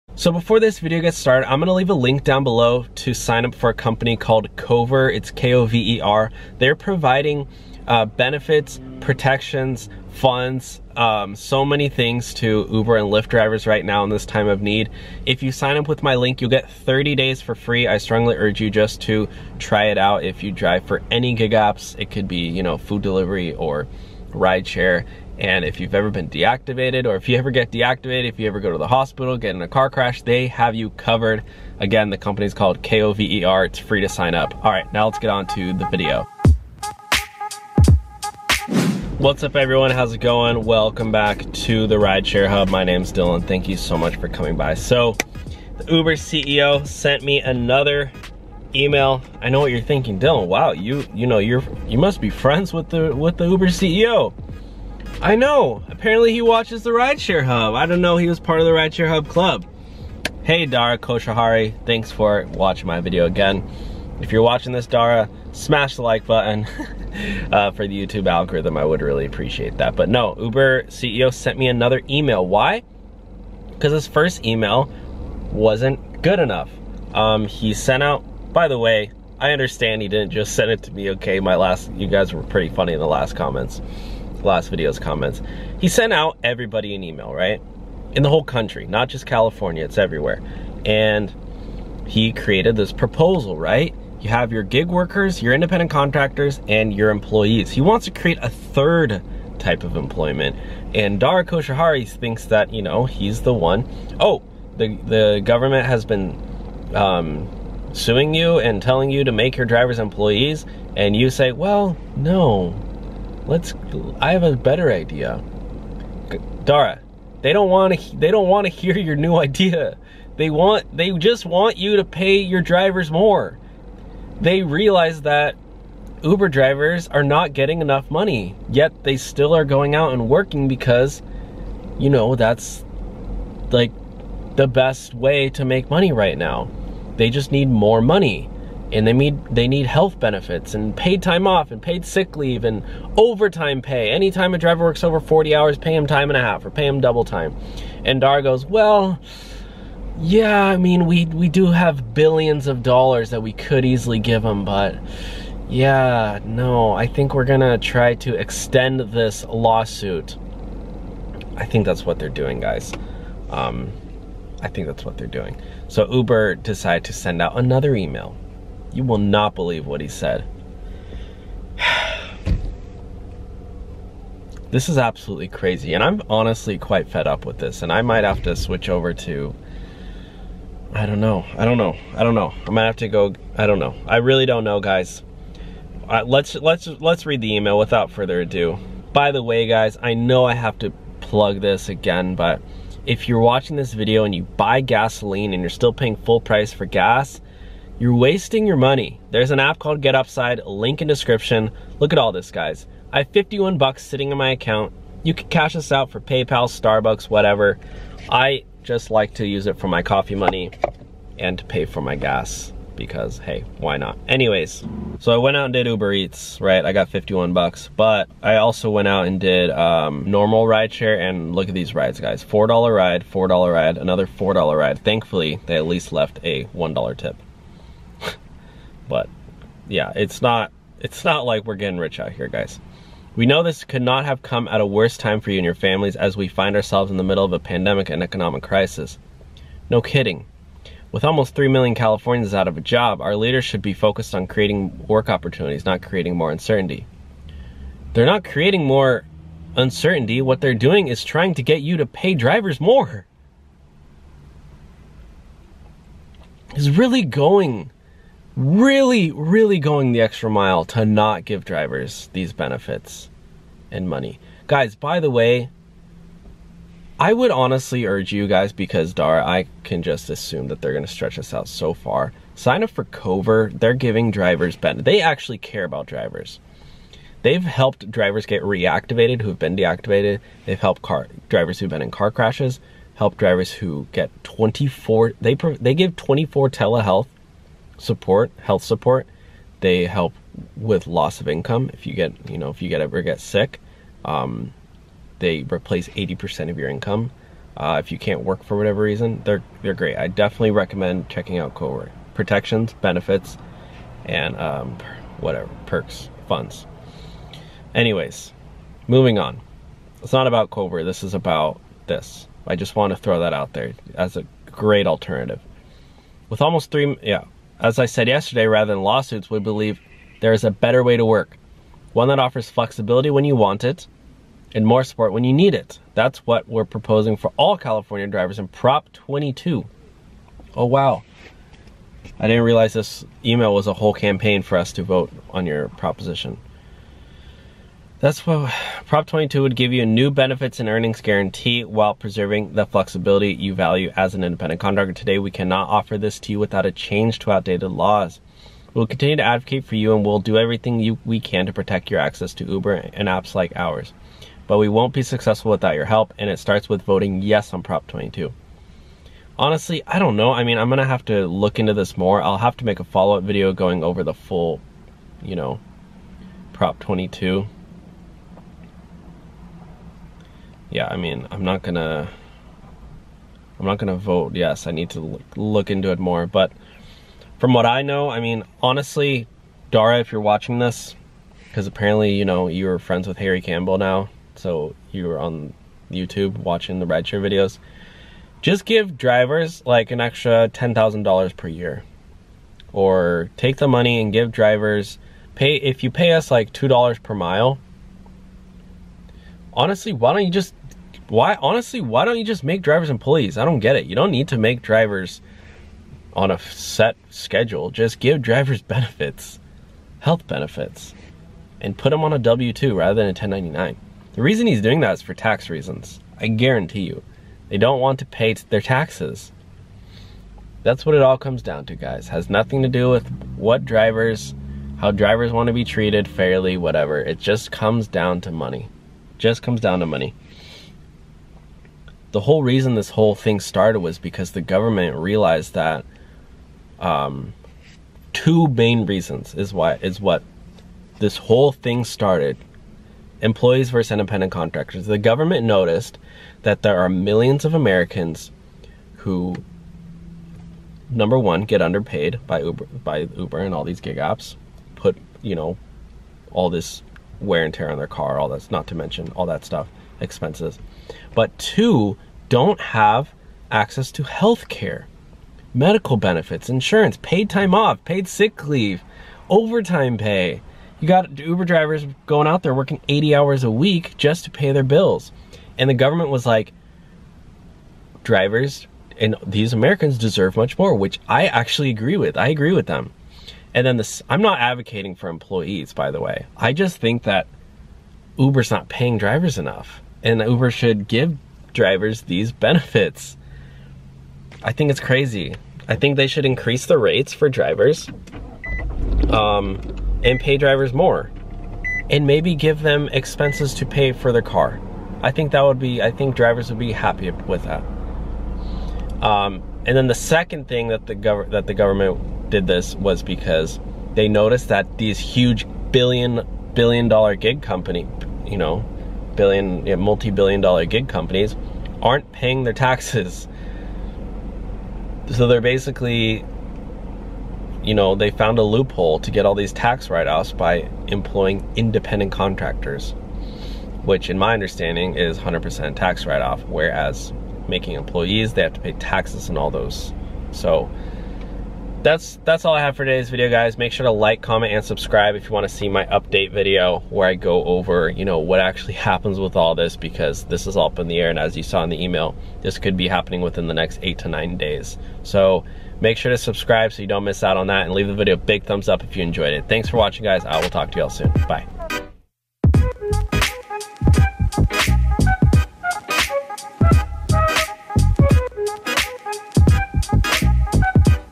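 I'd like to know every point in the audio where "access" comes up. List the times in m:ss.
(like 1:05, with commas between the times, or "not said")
5:52, 7:43.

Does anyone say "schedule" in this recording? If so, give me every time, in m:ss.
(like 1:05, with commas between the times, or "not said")
6:47.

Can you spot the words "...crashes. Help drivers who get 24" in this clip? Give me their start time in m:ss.
4:42.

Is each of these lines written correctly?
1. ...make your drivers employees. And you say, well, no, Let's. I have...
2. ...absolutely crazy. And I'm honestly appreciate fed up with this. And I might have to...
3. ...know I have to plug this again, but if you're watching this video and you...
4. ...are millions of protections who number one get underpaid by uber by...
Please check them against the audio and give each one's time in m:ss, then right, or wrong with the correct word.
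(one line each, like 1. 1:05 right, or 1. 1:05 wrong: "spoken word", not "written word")
1. 1:49 right
2. 2:54 wrong: "quite", not "appreciate"
3. 3:10 right
4. 7:26 wrong: "americans", not "protections".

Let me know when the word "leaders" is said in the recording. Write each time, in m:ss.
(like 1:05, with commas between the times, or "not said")
4:03.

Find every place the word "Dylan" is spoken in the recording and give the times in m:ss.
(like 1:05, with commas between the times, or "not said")
0:43, 0:50.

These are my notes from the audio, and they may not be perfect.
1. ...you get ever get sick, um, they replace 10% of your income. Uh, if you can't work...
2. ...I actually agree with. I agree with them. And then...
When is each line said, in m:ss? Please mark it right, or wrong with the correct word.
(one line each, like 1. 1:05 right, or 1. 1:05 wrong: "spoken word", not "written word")
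1. 4:52 wrong: "80", not "10"
2. 8:01 right.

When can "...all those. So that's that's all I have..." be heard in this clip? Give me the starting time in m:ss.
8:59.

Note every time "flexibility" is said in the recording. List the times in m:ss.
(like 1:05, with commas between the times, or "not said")
5:22, 5:42.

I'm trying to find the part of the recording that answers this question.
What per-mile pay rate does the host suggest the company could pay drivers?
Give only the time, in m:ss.
6:36.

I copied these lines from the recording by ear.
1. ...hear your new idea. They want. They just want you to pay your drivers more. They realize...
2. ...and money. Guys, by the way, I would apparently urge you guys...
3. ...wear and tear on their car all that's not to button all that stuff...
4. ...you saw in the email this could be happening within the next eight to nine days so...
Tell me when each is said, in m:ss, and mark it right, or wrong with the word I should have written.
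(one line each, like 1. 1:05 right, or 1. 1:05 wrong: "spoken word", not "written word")
1. 1:58 right
2. 4:23 wrong: "honestly", not "apparently"
3. 7:37 wrong: "mention", not "button"
4. 9:11 right.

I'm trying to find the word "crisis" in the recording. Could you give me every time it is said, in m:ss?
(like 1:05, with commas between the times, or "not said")
3:58.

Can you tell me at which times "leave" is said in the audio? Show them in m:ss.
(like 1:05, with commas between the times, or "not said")
0:01, 2:22, 7:48, 9:17.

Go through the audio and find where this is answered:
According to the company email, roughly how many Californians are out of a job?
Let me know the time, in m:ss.
4:01.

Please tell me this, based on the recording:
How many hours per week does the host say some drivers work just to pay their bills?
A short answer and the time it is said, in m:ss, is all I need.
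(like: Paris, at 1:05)
80, at 7:53.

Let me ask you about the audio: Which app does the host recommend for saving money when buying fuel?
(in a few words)
Get Upside.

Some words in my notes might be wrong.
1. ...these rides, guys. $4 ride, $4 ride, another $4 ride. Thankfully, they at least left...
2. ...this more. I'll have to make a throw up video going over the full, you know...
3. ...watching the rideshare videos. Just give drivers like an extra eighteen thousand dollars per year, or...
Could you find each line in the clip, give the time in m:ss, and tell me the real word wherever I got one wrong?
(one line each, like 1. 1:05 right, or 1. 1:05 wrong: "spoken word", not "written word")
1. 3:41 right
2. 6:01 wrong: "follow", not "throw"
3. 6:26 wrong: "ten", not "eighteen".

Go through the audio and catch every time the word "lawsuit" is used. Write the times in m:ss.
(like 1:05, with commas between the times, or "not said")
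2:39, 5:19.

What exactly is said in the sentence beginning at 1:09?
But no, Uber CEO sent me another email.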